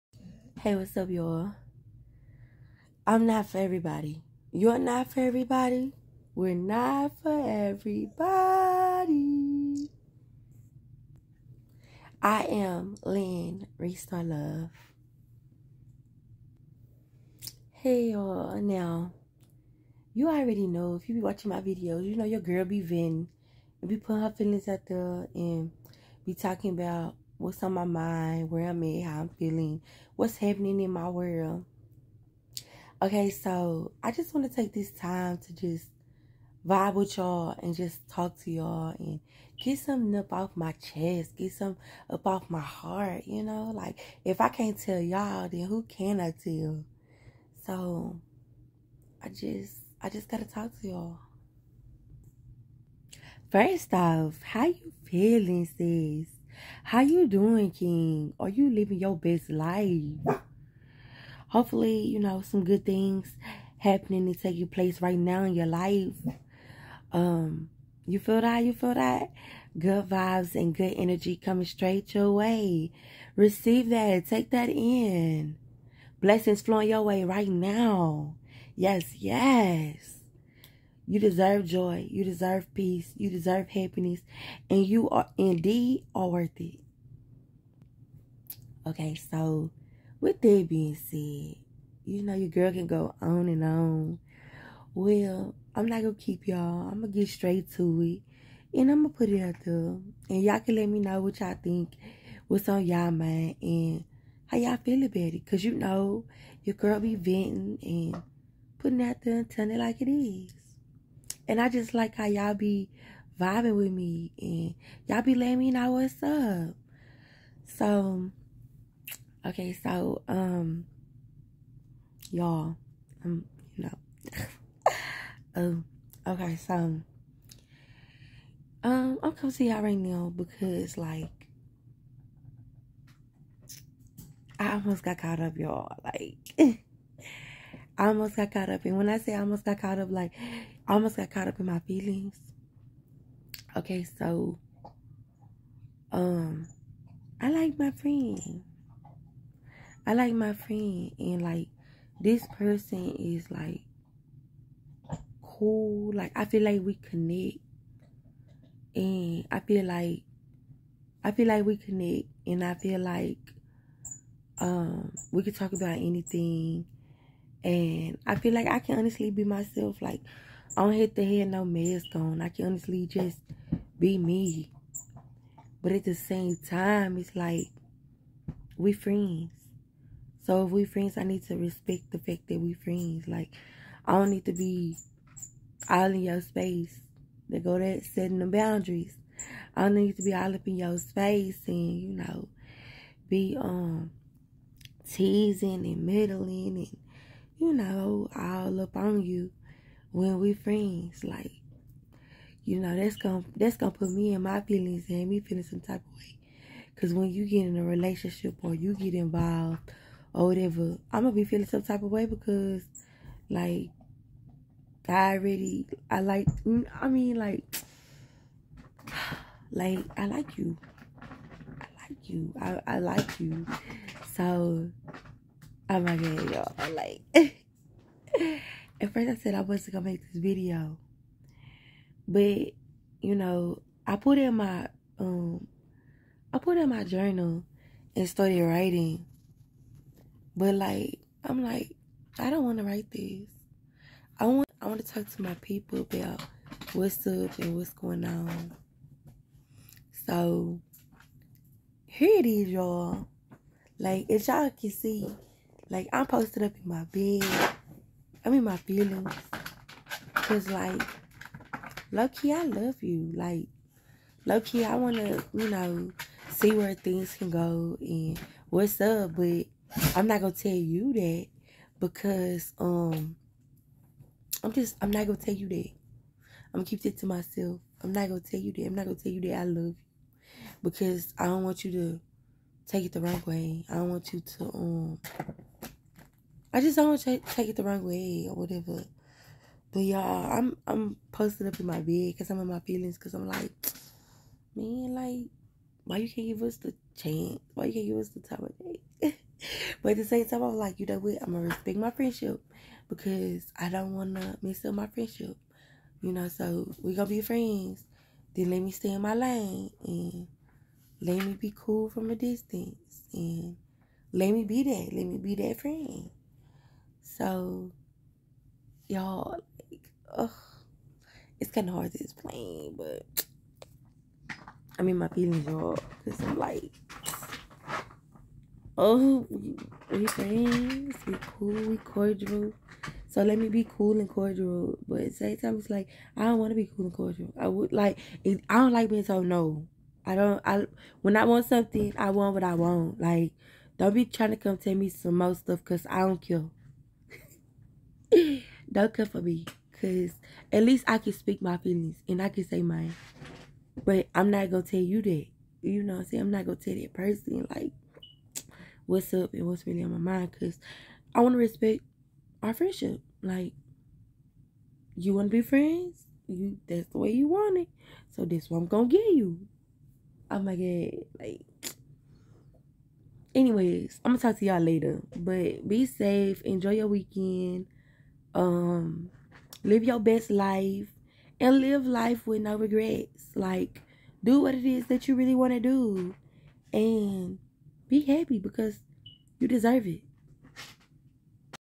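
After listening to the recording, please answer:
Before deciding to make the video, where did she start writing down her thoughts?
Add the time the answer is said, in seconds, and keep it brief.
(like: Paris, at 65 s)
journal, at 237 s.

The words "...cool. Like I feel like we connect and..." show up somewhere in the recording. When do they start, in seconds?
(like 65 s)
155 s.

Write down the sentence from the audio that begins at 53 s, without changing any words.
First off, how you feeling, sis?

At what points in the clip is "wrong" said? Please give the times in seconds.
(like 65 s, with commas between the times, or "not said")
283 s, 287 s.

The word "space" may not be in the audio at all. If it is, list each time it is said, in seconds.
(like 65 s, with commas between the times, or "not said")
186 s, 190 s.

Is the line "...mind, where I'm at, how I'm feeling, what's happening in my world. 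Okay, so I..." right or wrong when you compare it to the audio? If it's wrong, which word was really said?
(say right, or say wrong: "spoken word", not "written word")
right.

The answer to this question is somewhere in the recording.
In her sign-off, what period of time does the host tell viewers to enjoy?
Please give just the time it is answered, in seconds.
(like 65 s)
377 s.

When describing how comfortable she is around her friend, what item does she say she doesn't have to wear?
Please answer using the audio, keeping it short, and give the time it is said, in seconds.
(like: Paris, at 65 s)
mask, at 171 s.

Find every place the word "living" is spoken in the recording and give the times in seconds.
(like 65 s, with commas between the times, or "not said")
58 s.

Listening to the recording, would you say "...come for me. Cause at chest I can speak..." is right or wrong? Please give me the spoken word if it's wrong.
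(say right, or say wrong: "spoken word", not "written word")
wrong: "least", not "chest".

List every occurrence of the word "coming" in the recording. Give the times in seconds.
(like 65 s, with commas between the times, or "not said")
71 s, 129 s.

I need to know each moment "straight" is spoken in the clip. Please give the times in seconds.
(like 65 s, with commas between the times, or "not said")
71 s, 97 s.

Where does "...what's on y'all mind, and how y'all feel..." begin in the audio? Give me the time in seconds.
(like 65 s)
102 s.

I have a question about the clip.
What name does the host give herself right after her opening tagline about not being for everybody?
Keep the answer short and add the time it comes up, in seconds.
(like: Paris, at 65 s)
Lynn Restore Love, at 13 s.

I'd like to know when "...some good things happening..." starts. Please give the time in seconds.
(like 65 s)
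62 s.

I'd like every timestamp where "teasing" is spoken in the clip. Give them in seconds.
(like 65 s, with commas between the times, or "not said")
195 s.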